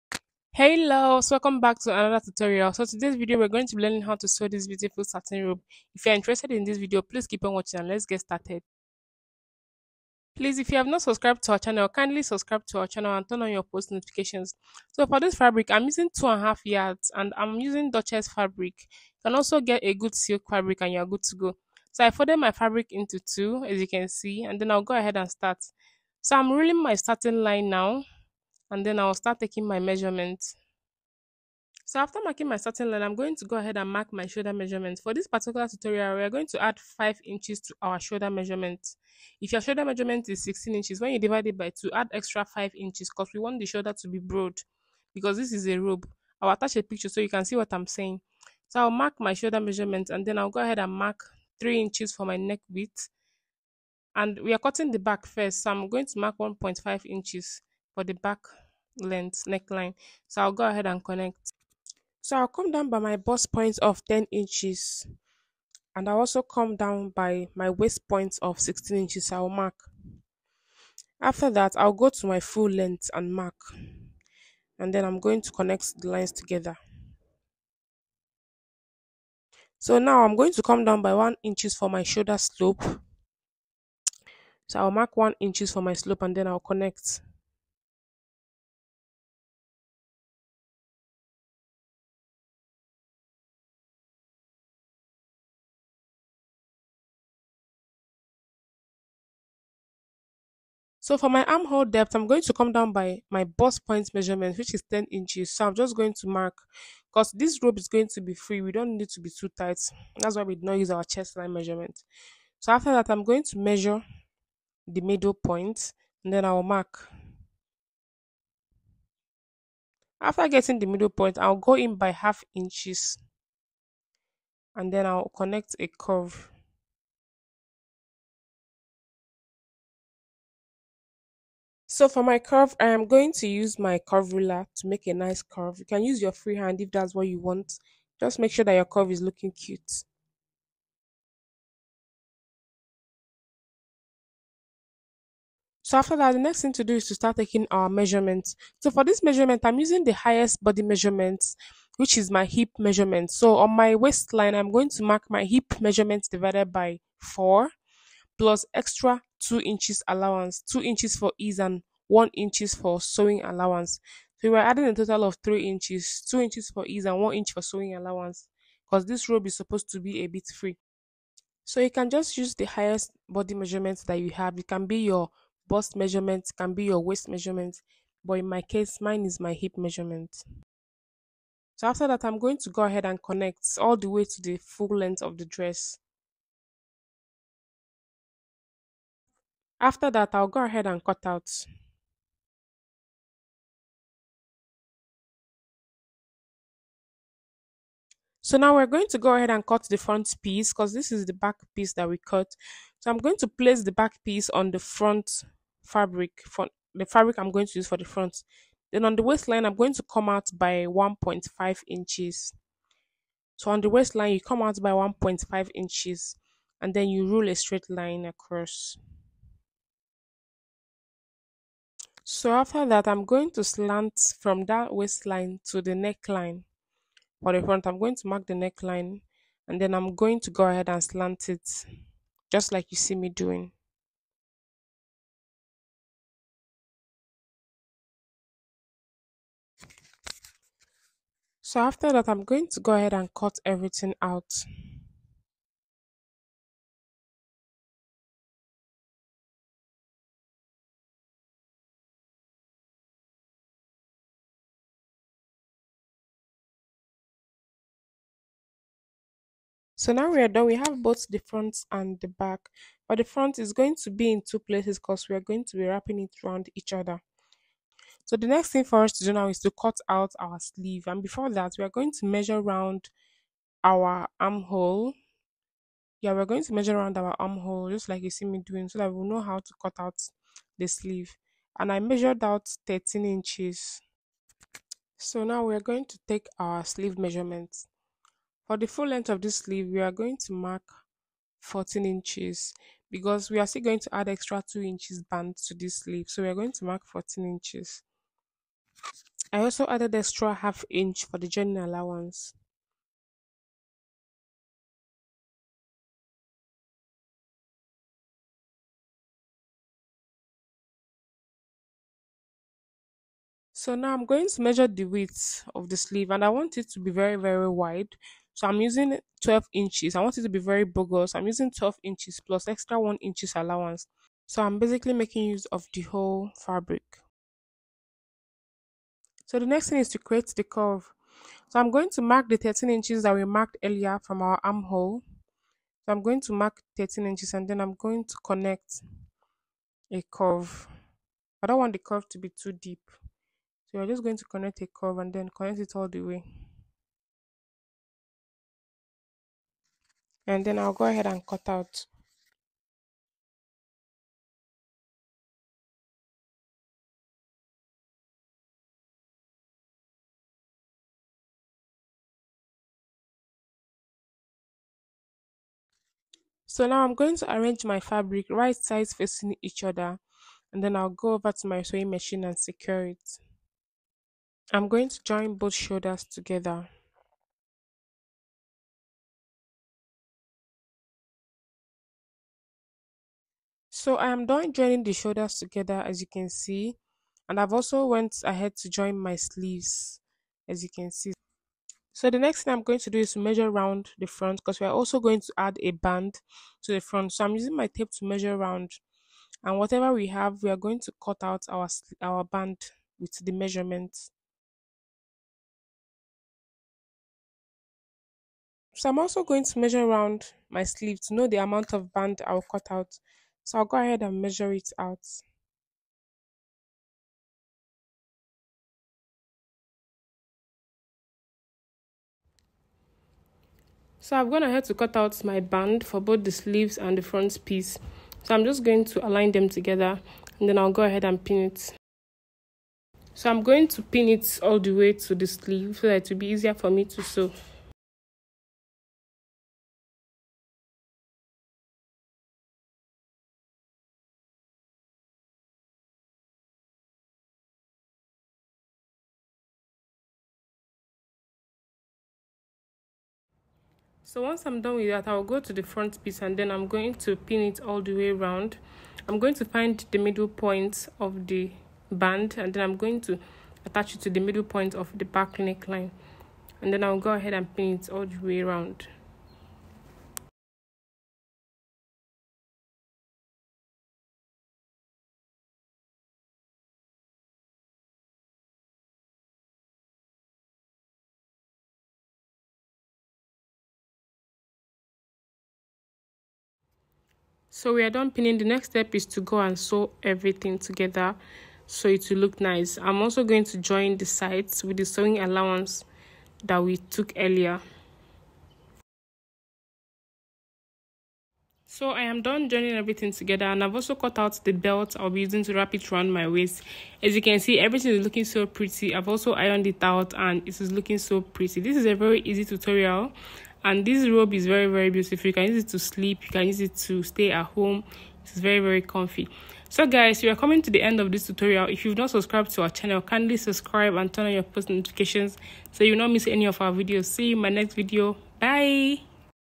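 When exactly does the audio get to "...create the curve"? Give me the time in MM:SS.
05:30.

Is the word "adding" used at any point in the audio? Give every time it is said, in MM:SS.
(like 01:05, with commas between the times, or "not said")
02:44.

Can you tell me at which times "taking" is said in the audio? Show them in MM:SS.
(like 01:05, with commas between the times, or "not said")
00:29, 02:27.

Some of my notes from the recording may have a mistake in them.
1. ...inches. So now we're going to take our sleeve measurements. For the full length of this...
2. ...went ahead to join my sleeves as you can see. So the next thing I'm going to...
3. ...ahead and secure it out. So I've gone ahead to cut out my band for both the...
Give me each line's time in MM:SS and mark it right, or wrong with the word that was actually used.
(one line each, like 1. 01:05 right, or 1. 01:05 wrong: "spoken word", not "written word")
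1. 04:43 right
2. 06:28 right
3. 06:53 wrong: "measure", not "secure".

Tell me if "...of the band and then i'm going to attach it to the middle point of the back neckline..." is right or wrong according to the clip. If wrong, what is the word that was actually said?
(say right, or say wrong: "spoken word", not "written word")
right.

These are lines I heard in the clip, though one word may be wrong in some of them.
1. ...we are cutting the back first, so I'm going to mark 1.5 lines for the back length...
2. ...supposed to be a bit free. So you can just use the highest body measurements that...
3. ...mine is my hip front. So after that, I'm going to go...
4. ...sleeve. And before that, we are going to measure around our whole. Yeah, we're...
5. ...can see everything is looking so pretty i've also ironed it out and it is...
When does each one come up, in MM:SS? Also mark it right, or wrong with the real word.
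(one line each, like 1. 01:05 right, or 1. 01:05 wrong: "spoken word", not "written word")
1. 00:54 wrong: "inches", not "lines"
2. 02:49 right
3. 02:58 wrong: "measurement", not "front"
4. 04:30 wrong: "armhole", not "whole"
5. 08:27 right.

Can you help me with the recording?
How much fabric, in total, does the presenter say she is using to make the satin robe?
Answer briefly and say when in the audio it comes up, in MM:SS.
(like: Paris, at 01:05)
2.5 yards, at 00:16.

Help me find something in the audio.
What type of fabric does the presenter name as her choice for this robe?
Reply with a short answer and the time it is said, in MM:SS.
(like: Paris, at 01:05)
Duchess fabric, at 00:17.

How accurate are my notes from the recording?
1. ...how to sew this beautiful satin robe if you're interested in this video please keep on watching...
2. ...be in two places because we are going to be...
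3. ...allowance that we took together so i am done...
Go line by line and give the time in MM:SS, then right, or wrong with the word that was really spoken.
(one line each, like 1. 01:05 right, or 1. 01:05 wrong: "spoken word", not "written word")
1. 00:04 right
2. 04:24 right
3. 08:15 wrong: "earlier", not "together".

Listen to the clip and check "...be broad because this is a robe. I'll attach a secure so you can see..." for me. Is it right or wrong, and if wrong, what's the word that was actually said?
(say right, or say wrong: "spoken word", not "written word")
wrong: "picture", not "secure".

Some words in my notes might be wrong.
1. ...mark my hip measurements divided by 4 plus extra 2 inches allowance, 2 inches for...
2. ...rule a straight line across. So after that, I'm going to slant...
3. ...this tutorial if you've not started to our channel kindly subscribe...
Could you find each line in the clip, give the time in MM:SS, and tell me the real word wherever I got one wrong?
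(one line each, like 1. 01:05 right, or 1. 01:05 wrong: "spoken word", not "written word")
1. 02:35 right
2. 03:37 right
3. 08:41 wrong: "subscribed", not "started".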